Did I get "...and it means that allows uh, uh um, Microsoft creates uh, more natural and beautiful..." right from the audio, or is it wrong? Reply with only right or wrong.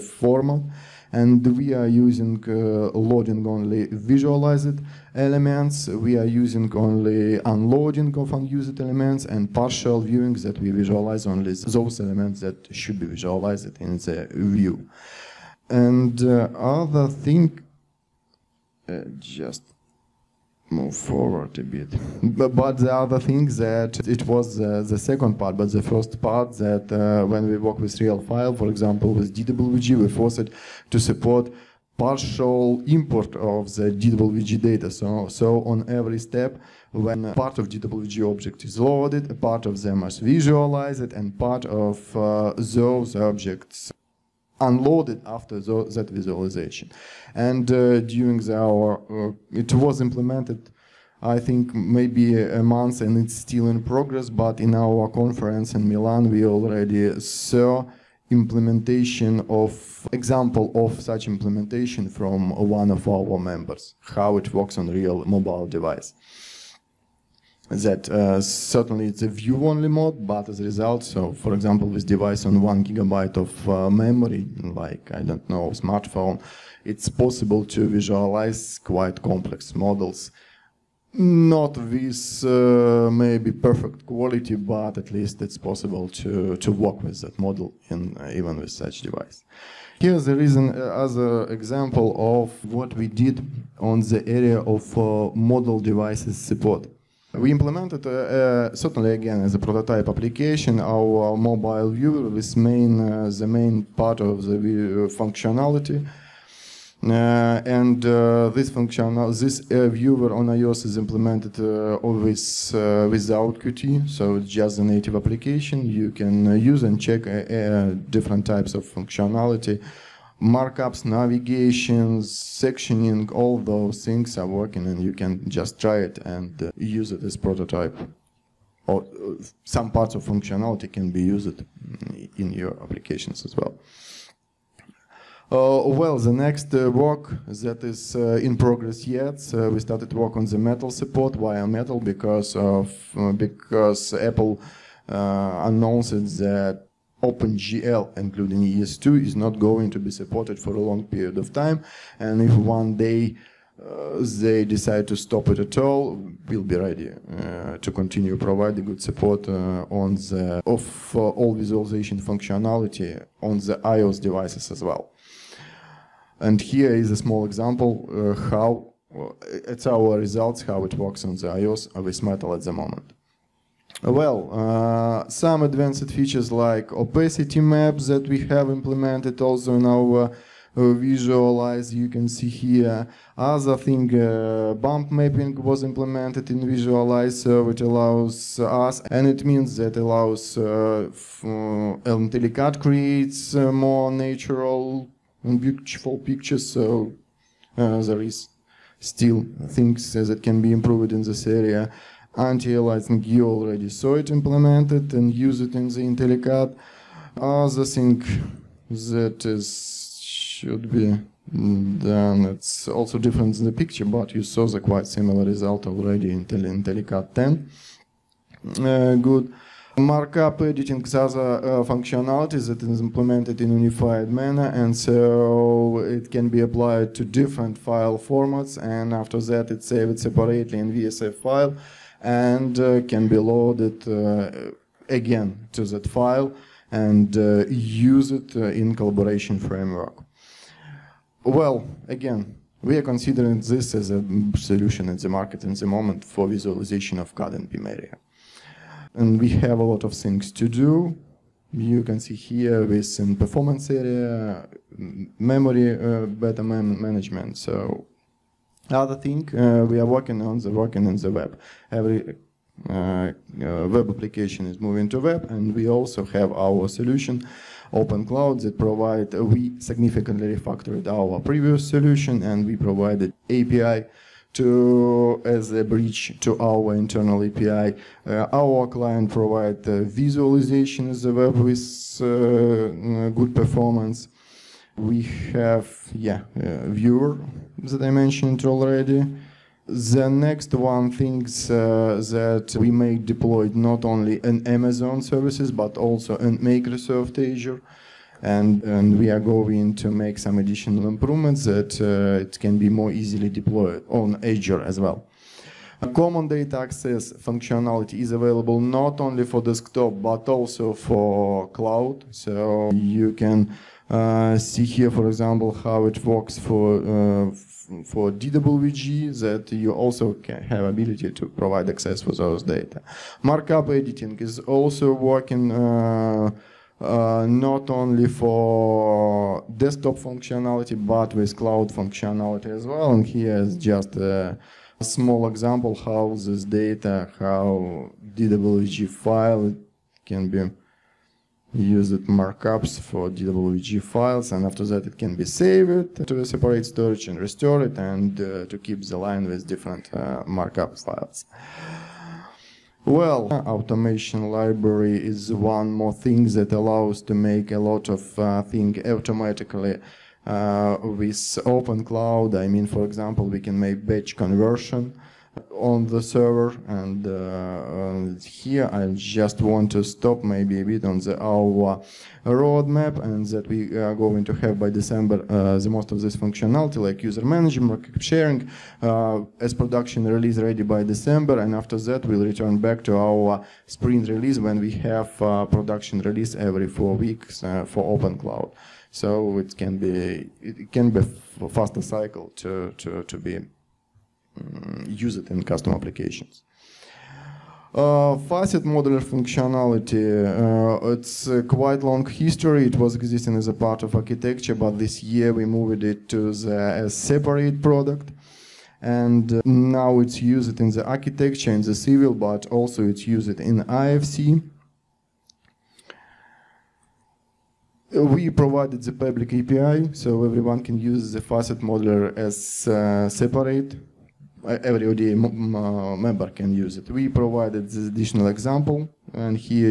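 wrong.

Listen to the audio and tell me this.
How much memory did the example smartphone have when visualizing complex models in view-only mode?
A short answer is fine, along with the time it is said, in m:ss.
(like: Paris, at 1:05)
1 gigabyte, at 1:12.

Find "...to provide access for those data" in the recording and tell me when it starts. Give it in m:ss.
5:21.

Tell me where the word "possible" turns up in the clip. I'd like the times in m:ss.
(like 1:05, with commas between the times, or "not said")
1:17, 1:25.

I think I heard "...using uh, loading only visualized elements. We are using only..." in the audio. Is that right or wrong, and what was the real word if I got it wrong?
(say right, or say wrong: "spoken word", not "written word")
right.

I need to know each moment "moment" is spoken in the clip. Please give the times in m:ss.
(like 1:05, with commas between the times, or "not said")
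2:52, 4:05.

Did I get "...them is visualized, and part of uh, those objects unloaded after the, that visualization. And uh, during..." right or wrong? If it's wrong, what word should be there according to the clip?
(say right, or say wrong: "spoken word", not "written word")
right.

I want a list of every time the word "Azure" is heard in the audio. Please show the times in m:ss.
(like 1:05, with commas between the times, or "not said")
4:57, 5:04.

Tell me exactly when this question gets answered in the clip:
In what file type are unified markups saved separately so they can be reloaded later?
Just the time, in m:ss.
3:50.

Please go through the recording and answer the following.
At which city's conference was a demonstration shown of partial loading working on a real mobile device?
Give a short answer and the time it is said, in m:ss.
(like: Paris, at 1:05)
Milan, at 0:55.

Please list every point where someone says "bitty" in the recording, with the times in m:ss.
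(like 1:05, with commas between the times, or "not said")
not said.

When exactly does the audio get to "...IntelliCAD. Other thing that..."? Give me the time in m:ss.
3:25.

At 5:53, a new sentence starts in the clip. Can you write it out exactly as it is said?
Well, automation library is one more thing that allows to make a lot of uh, automatically uh, with open cloud.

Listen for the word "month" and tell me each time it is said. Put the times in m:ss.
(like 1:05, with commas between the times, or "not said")
0:52.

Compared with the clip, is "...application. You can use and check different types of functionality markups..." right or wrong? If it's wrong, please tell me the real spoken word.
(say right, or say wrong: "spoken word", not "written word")
right.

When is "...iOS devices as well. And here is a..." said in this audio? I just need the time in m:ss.
2:43.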